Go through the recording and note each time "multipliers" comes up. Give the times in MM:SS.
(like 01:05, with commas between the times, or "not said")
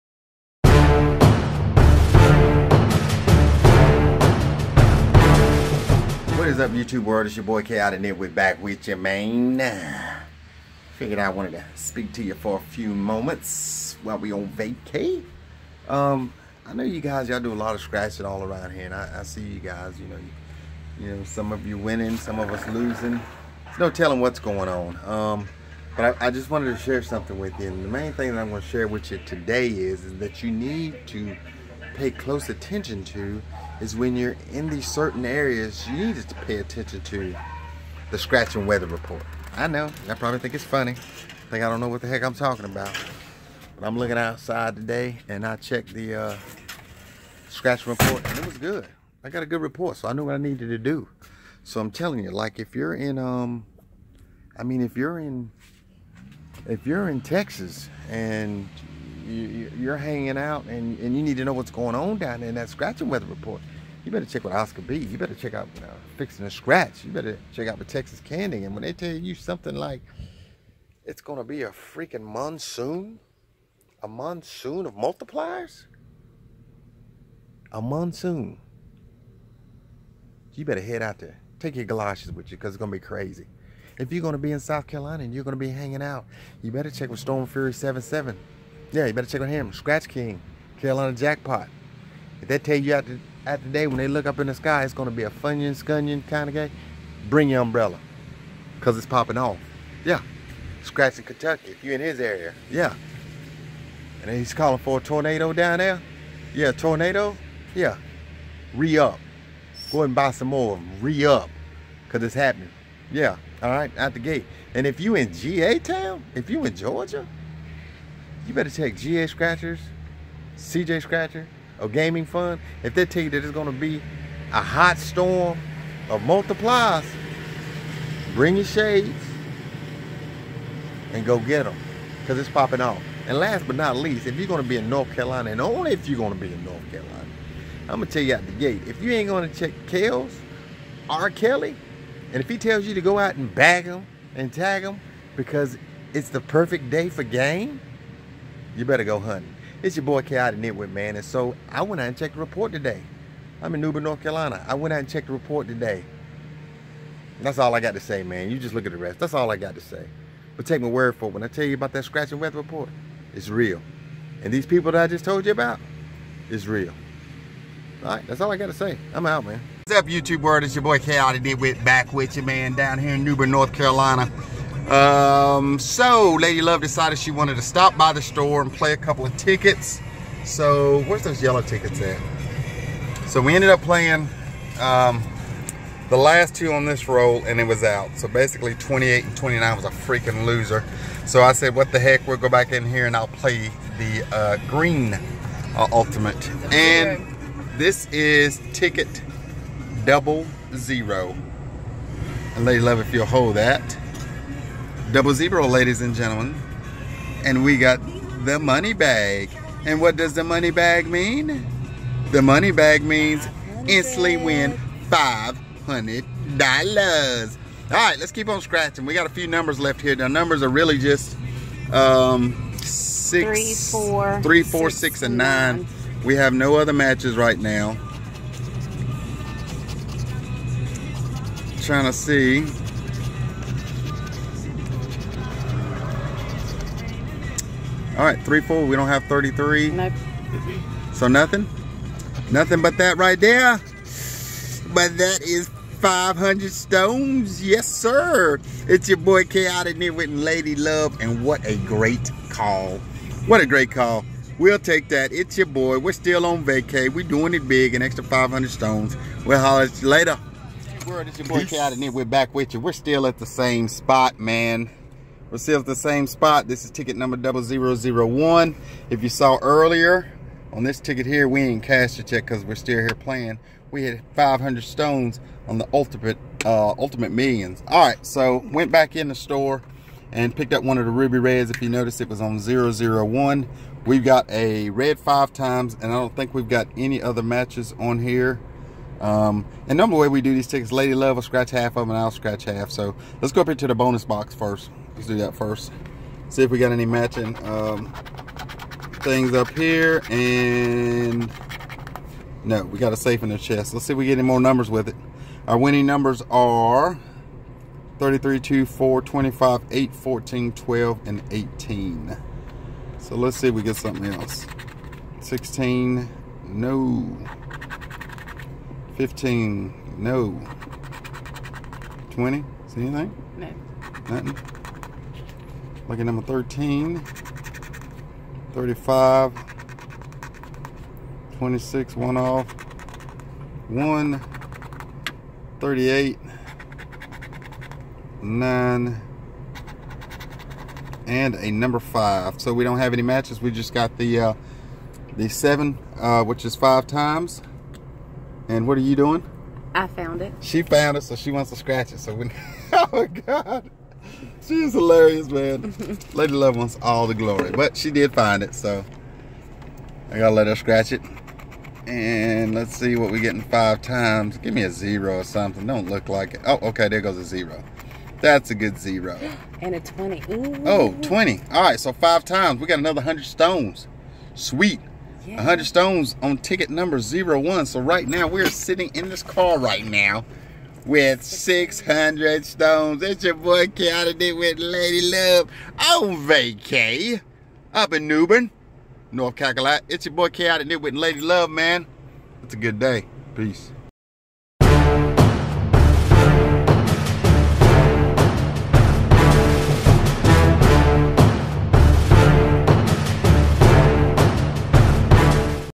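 01:14, 02:06.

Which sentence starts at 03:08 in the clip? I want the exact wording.
So basically 28 and 29 was a freaking loser.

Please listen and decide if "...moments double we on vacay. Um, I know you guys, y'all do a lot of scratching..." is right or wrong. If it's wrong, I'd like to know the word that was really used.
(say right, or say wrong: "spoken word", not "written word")
wrong: "while", not "double".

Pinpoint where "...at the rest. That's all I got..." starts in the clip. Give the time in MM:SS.
02:38.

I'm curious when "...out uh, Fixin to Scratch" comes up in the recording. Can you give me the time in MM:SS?
01:05.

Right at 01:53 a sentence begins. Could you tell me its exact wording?
Yeah, all right, out the gate.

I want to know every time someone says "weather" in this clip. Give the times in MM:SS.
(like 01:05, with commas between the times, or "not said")
00:38, 01:03, 02:42.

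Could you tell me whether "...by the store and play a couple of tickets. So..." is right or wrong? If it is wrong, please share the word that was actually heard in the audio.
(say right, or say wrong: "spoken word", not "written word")
right.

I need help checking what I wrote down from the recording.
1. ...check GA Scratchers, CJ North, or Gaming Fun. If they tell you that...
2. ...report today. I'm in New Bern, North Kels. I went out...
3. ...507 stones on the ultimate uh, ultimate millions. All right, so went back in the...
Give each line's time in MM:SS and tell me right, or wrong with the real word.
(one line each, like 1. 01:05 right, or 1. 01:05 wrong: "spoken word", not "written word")
1. 01:58 wrong: "Scratcher", not "North"
2. 02:32 wrong: "Carolina", not "Kels"
3. 04:34 wrong: "500", not "507".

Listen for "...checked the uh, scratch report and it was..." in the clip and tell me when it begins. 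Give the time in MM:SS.
00:45.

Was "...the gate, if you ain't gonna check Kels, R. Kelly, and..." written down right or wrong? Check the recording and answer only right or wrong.
right.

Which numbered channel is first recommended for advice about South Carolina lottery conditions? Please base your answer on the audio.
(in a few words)
Storm Fury 77.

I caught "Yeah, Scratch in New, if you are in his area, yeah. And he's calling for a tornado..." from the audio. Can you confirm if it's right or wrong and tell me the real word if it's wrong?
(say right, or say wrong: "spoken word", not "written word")
wrong: "Kentucky", not "New".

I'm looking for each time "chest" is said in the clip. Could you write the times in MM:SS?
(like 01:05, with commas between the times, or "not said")
05:03.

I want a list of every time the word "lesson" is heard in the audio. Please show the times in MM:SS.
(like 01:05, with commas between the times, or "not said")
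not said.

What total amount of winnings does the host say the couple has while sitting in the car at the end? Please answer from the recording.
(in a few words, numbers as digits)
600.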